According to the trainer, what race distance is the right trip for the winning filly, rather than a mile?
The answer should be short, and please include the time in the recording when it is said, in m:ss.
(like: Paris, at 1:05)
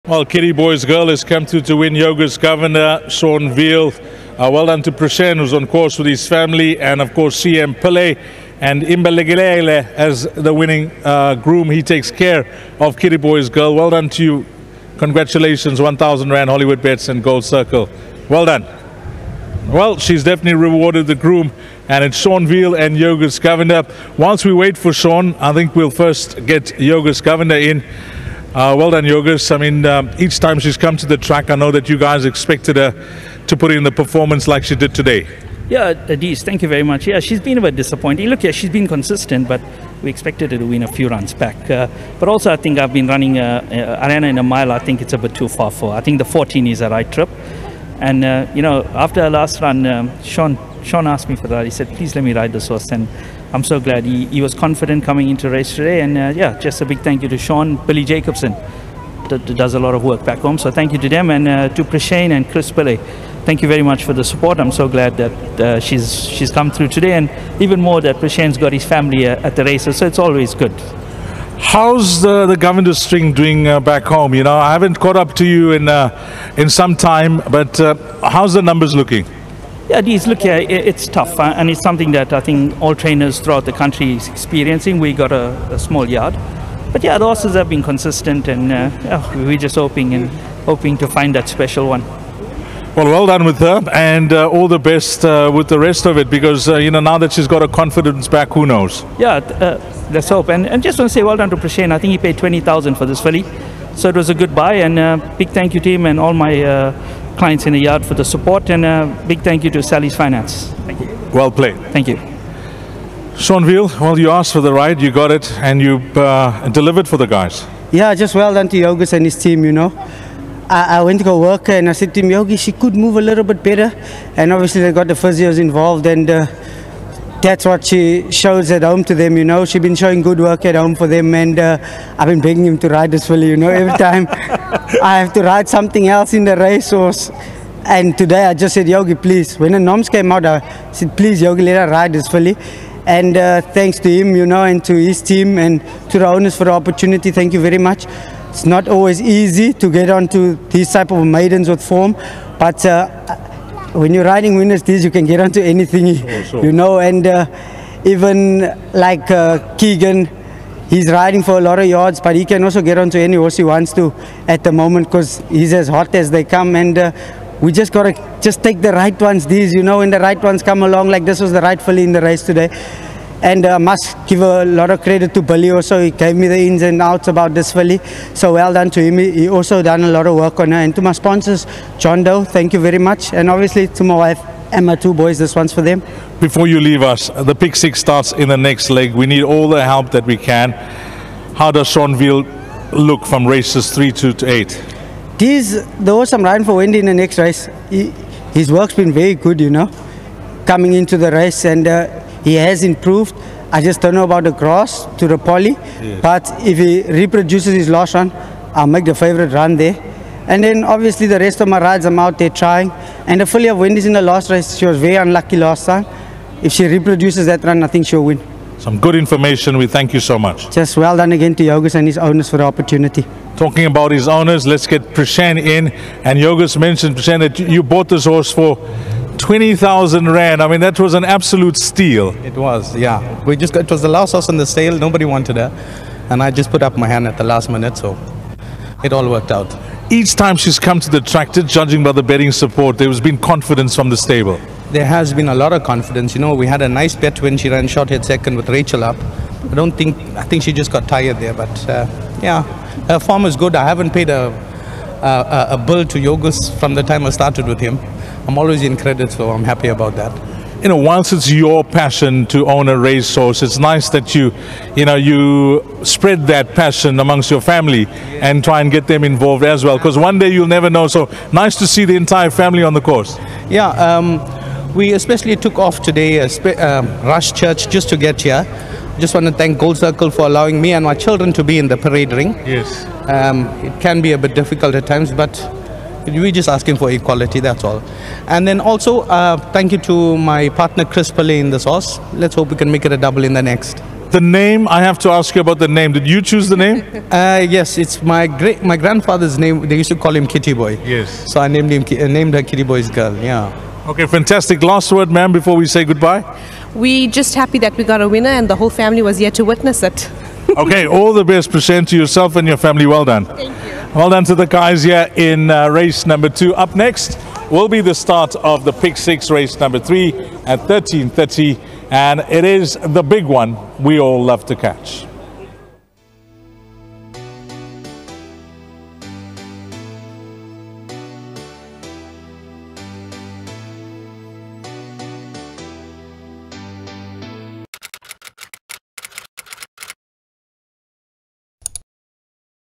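1400, at 0:46.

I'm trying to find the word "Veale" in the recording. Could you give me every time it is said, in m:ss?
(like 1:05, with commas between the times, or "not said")
0:03, 0:22, 1:53, 3:12.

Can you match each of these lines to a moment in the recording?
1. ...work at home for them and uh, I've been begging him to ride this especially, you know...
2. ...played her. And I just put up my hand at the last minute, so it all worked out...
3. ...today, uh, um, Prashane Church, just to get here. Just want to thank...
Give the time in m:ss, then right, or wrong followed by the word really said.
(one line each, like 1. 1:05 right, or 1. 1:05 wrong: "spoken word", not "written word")
1. 2:10 wrong: "filly", not "especially"
2. 3:55 wrong: "wanted", not "played"
3. 4:36 wrong: "Rush", not "Prashane".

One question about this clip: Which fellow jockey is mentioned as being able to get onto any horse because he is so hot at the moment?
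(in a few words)
Keegan.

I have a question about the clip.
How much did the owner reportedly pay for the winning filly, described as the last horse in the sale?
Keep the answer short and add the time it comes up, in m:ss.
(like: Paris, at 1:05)
20,000 Rand, at 1:42.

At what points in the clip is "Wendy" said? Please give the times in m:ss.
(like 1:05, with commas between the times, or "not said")
3:16, 3:33.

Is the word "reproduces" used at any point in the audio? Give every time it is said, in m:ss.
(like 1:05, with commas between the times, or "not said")
3:27, 3:36.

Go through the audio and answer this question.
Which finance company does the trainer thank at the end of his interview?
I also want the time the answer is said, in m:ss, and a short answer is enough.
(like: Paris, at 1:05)
Sally's Finance, at 1:49.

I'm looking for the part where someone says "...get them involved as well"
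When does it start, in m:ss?
4:28.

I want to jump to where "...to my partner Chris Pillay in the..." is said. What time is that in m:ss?
4:49.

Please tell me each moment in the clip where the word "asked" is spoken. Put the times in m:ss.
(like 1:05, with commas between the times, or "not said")
0:51, 1:54.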